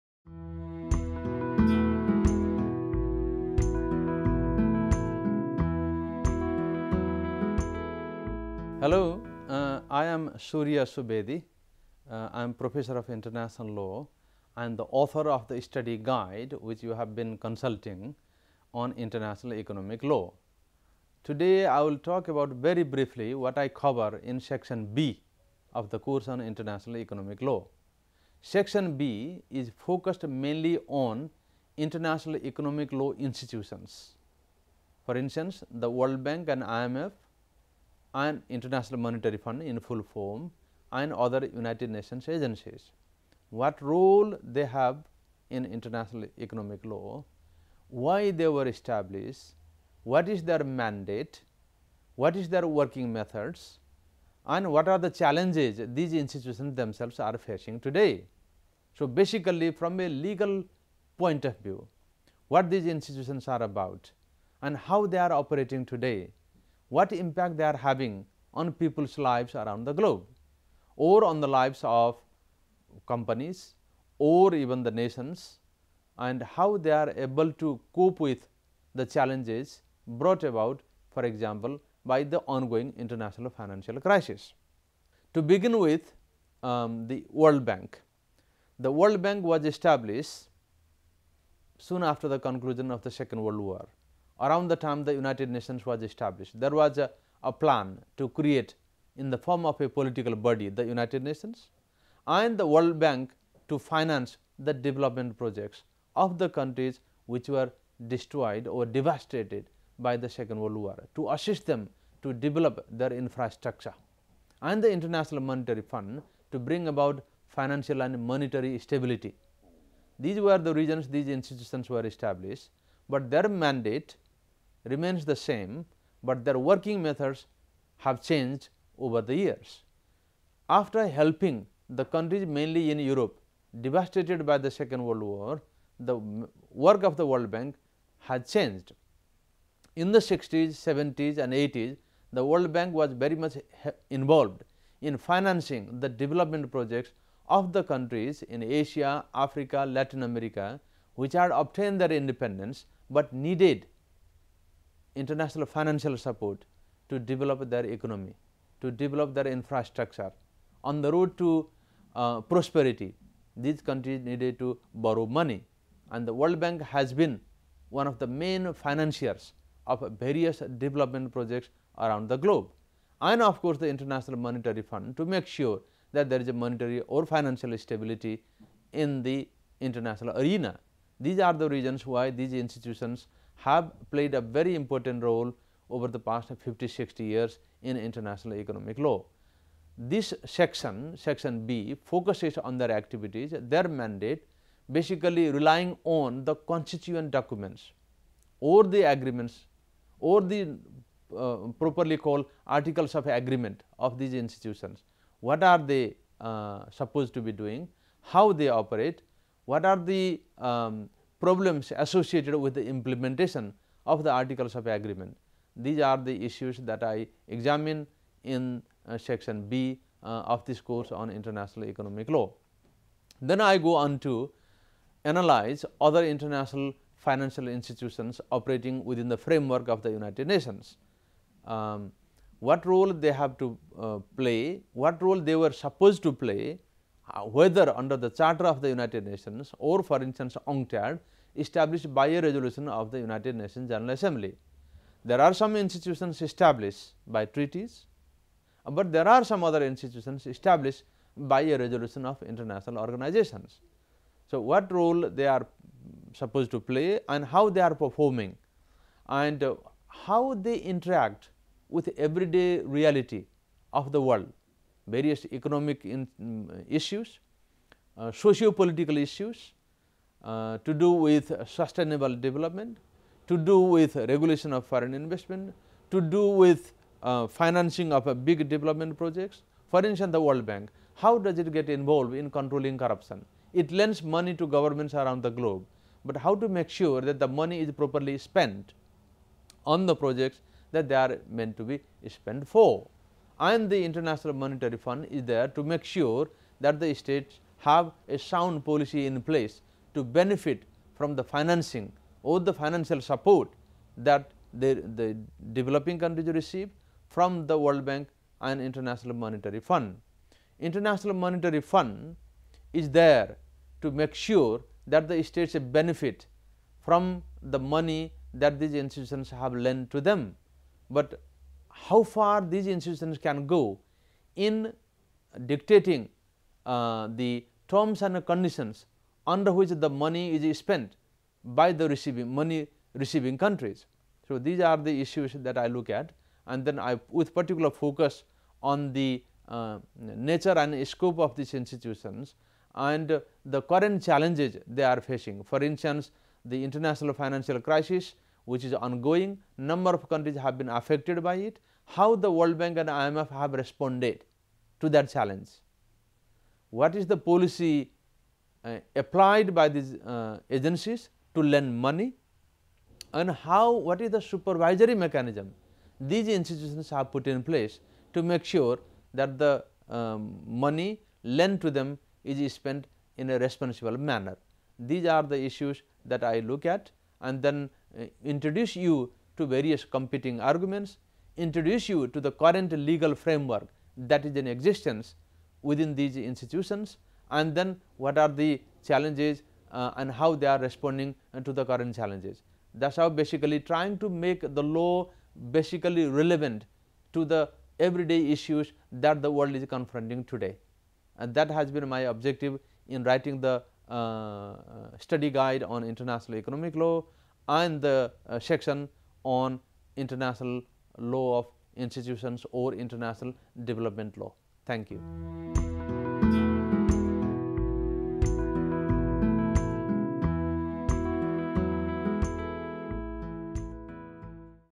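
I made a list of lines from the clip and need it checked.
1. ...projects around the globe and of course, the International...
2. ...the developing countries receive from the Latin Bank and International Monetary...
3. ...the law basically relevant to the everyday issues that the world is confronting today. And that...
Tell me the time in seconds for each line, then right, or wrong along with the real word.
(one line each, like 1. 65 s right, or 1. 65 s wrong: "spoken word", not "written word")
1. 171 s right
2. 305 s wrong: "World", not "Latin"
3. 394 s right.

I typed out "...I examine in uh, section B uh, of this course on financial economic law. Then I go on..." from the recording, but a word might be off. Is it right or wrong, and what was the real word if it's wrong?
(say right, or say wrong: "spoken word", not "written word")
wrong: "international", not "financial".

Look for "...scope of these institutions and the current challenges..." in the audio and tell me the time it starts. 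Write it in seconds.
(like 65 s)
341 s.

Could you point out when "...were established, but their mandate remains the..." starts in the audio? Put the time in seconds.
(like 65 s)
121 s.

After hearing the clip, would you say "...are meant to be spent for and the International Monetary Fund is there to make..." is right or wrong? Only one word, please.
right.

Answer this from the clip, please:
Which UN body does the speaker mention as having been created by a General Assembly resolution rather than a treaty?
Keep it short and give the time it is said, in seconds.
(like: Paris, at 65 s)
UNCTAD, at 240 s.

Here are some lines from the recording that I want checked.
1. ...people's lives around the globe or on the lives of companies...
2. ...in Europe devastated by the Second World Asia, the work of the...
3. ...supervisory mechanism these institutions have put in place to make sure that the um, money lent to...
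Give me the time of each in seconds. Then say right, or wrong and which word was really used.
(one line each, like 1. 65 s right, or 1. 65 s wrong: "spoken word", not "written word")
1. 68 s right
2. 132 s wrong: "War", not "Asia"
3. 364 s right.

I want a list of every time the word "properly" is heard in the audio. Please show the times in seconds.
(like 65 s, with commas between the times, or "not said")
201 s, 287 s.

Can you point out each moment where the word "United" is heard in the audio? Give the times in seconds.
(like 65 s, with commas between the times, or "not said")
41 s, 95 s, 100 s, 230 s, 238 s, 243 s.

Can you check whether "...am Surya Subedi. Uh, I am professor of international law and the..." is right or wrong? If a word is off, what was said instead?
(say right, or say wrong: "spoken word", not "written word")
right.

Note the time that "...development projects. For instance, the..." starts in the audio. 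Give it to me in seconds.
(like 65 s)
278 s.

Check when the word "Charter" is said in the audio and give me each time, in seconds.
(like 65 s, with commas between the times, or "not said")
238 s.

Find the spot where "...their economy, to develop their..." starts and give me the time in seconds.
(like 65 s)
157 s.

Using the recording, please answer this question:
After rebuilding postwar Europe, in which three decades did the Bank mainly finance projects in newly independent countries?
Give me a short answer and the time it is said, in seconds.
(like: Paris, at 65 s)
60s, 70s and 80s, at 140 s.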